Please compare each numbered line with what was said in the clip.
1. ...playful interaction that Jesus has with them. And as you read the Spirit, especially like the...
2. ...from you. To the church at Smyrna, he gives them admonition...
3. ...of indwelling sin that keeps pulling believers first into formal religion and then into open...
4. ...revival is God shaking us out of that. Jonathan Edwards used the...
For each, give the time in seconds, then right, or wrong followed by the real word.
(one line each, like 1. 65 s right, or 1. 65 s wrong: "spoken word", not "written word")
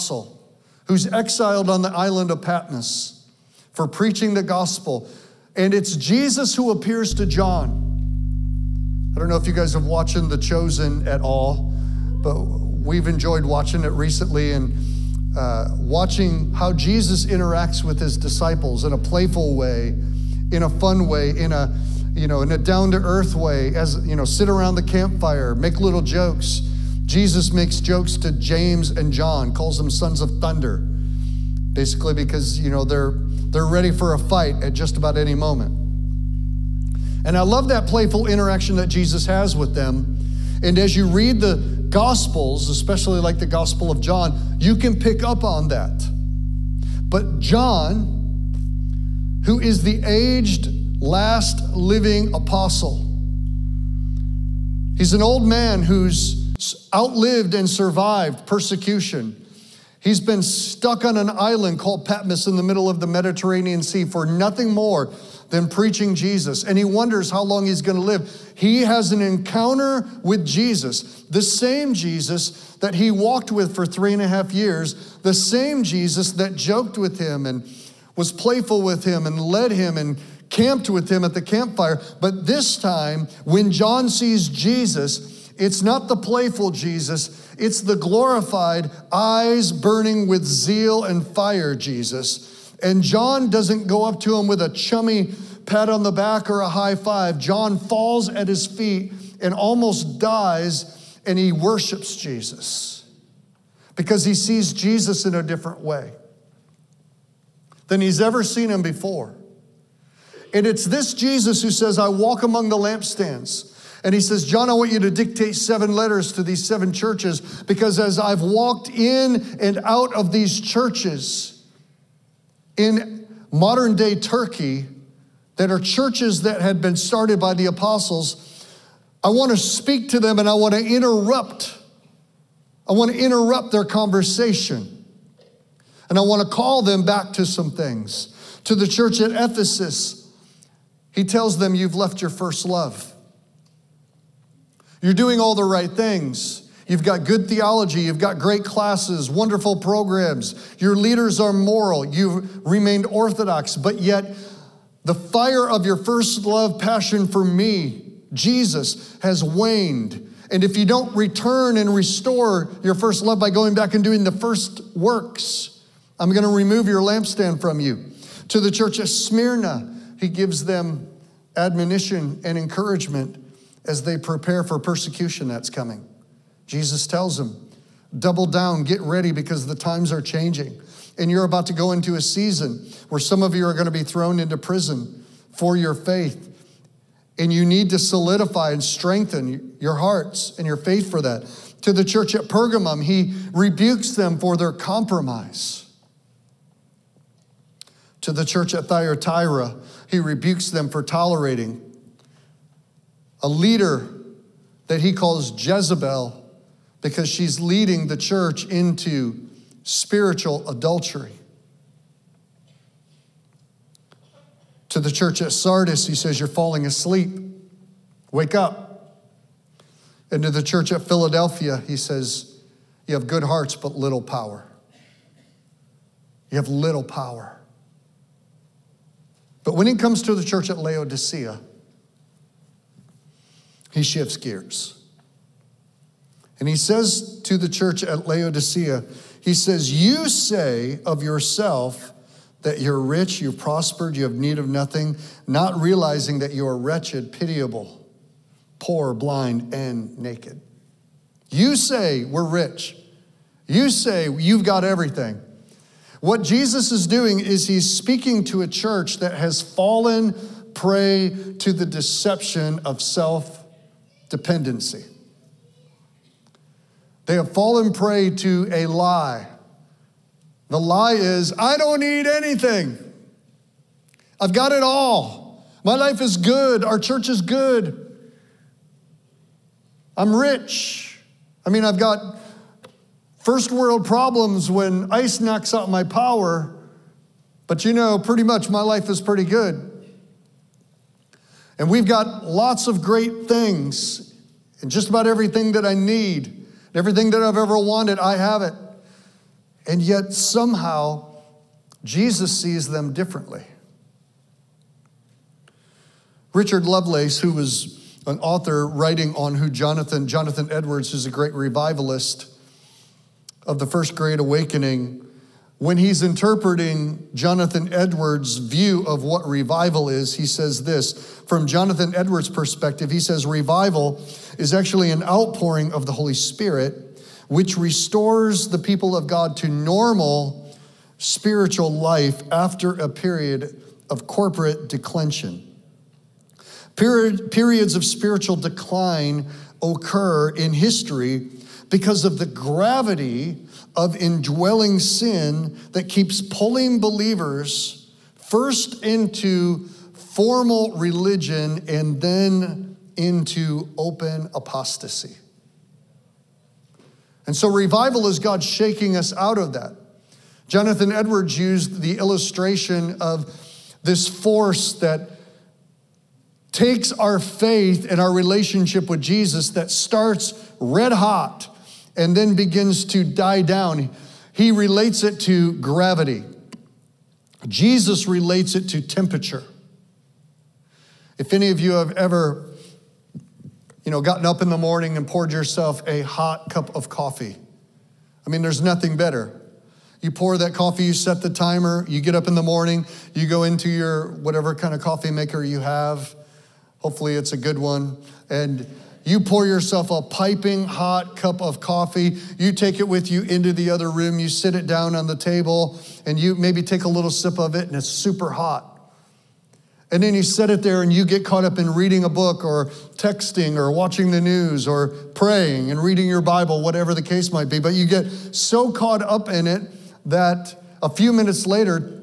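1. 37 s wrong: "Gospels", not "Spirit"
2. 167 s right
3. 343 s right
4. 357 s right.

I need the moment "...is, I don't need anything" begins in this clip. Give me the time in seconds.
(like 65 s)
271 s.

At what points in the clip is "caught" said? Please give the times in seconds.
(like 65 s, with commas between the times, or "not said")
411 s, 418 s.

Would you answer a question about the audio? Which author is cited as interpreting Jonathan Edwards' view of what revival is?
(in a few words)
Richard Lovelace.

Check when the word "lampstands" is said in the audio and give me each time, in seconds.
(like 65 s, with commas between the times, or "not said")
112 s, 167 s.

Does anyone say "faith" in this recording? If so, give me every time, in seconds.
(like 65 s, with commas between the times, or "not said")
185 s, 190 s, 367 s.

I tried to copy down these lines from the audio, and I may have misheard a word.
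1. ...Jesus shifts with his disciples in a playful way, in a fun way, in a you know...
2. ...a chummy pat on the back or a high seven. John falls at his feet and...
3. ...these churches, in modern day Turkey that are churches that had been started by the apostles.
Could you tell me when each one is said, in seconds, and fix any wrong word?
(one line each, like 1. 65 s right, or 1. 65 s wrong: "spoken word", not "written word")
1. 16 s wrong: "interacts", not "shifts"
2. 94 s wrong: "five", not "seven"
3. 120 s right.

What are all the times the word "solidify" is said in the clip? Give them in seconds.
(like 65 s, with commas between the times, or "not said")
187 s.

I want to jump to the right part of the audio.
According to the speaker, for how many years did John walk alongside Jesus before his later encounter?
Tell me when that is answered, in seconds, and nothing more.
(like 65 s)
73 s.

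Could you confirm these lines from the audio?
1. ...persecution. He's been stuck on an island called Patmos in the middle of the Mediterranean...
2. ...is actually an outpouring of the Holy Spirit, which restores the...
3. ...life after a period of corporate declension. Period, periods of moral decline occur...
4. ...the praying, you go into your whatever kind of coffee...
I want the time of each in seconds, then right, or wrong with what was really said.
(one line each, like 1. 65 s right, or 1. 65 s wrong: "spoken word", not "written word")
1. 58 s right
2. 324 s right
3. 331 s wrong: "spiritual", not "moral"
4. 392 s wrong: "morning", not "praying".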